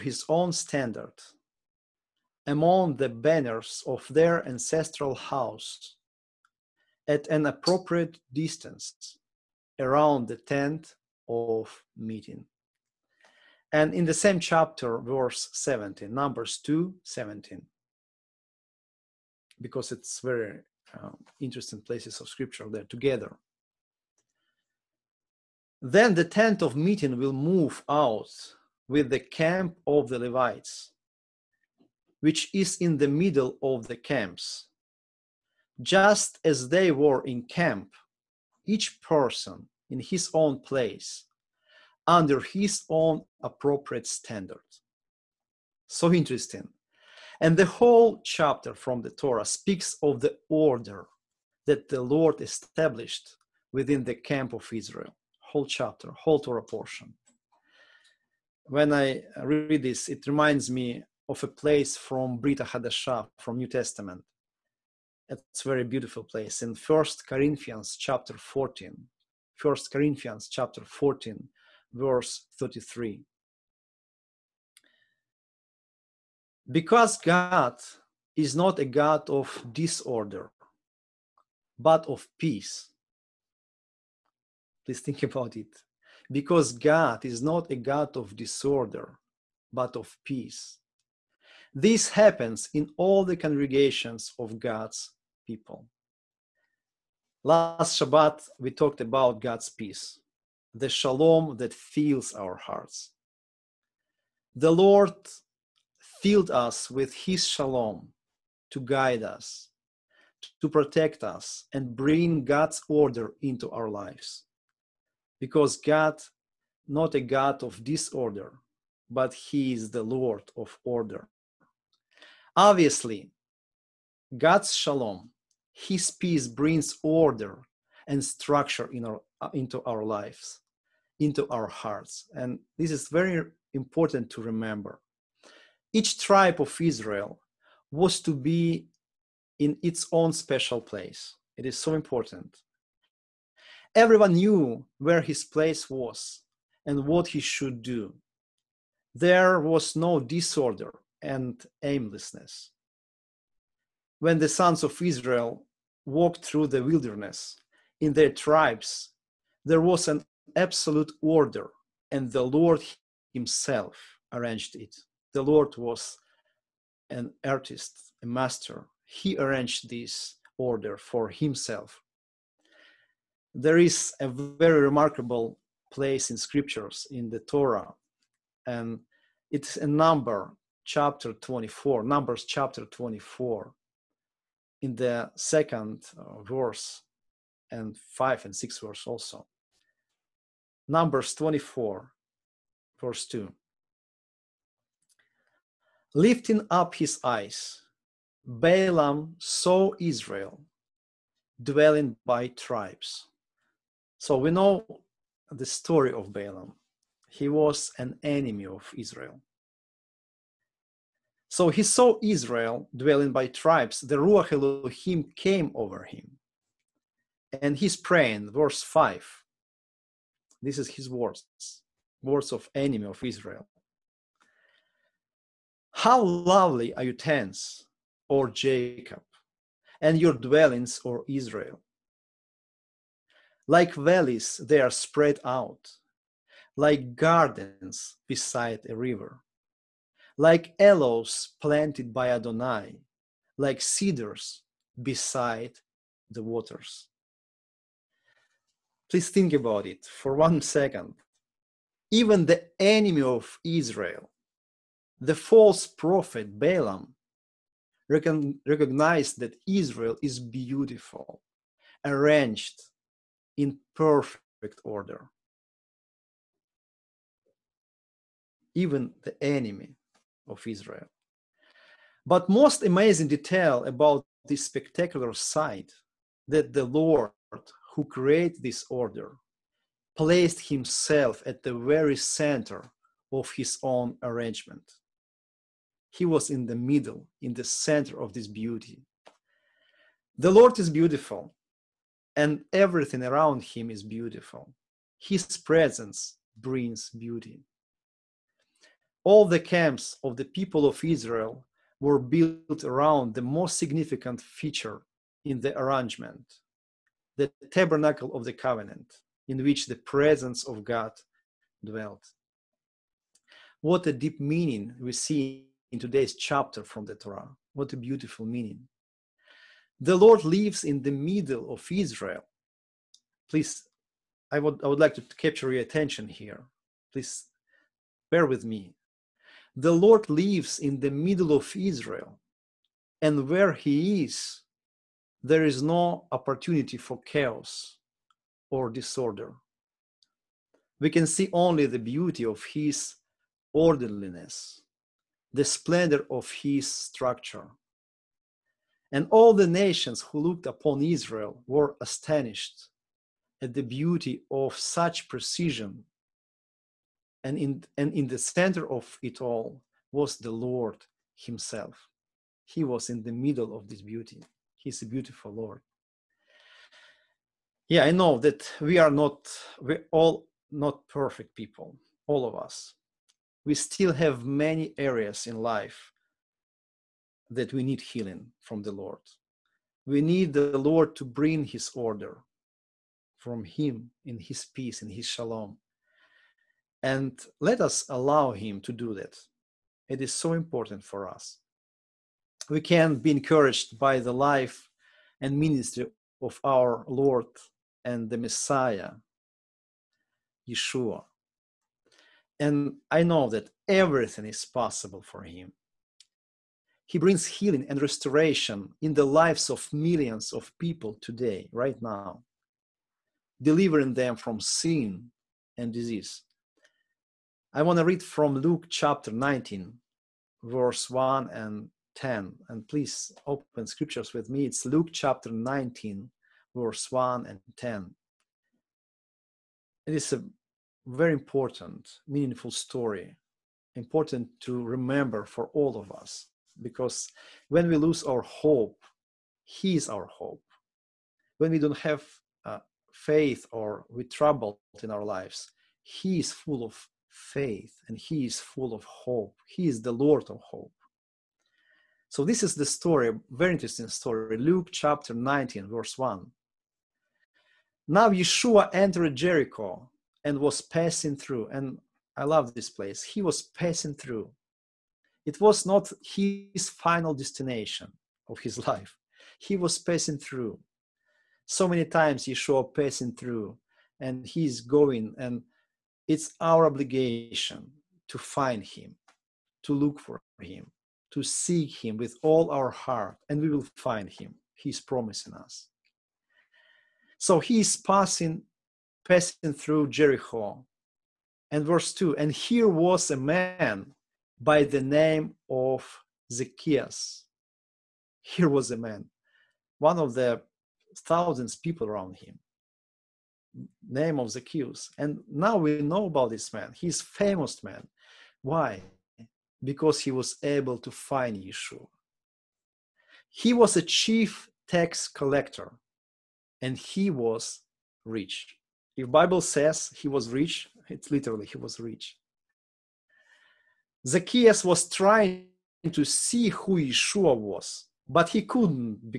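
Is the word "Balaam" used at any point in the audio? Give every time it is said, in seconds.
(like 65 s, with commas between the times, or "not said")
198 s, 206 s, 256 s.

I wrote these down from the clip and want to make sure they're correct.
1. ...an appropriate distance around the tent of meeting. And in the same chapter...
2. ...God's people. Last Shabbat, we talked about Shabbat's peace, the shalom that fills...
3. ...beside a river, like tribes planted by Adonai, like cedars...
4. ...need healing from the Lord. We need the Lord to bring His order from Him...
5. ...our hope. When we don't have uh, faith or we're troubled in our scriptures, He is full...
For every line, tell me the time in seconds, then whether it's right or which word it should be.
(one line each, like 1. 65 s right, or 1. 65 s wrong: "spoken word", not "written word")
1. 7 s right
2. 94 s wrong: "God", not "Shabbat"
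3. 238 s wrong: "aloes", not "tribes"
4. 377 s right
5. 440 s wrong: "lives", not "scriptures".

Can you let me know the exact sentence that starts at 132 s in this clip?
And this is very important to remember.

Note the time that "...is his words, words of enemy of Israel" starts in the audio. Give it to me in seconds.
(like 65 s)
220 s.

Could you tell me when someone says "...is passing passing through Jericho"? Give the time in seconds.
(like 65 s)
487 s.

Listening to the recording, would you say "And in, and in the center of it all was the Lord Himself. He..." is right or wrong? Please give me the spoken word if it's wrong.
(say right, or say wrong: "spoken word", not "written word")
right.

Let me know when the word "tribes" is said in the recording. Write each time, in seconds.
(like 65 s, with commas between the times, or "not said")
136 s, 158 s, 202 s, 213 s.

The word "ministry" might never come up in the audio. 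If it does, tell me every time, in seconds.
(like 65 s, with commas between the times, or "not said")
395 s.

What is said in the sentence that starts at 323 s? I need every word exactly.
Please, I would, I would like to capture your attention here.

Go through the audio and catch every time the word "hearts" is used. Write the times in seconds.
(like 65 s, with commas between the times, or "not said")
102 s, 131 s, 482 s.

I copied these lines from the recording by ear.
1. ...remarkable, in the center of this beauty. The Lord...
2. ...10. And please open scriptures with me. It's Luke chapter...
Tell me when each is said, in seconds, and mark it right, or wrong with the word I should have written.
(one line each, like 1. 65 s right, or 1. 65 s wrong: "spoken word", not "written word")
1. 286 s wrong: "middle", not "remarkable"
2. 422 s right.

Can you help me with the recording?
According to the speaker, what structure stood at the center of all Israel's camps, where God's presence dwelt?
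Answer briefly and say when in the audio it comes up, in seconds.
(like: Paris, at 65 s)
The tabernacle of the covenant, at 307 s.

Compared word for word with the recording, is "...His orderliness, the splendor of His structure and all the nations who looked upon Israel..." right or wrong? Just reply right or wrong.
right.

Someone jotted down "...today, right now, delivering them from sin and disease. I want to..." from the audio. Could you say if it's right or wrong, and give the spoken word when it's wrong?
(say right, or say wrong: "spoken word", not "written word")
right.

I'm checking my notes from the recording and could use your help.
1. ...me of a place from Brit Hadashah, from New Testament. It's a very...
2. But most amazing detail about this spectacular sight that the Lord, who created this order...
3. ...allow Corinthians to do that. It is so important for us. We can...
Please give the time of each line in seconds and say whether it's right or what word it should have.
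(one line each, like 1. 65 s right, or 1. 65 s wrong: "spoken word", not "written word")
1. 60 s right
2. 272 s right
3. 388 s wrong: "Him", not "Corinthians".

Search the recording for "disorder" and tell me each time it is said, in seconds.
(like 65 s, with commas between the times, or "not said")
79 s, 88 s, 117 s, 150 s, 338 s.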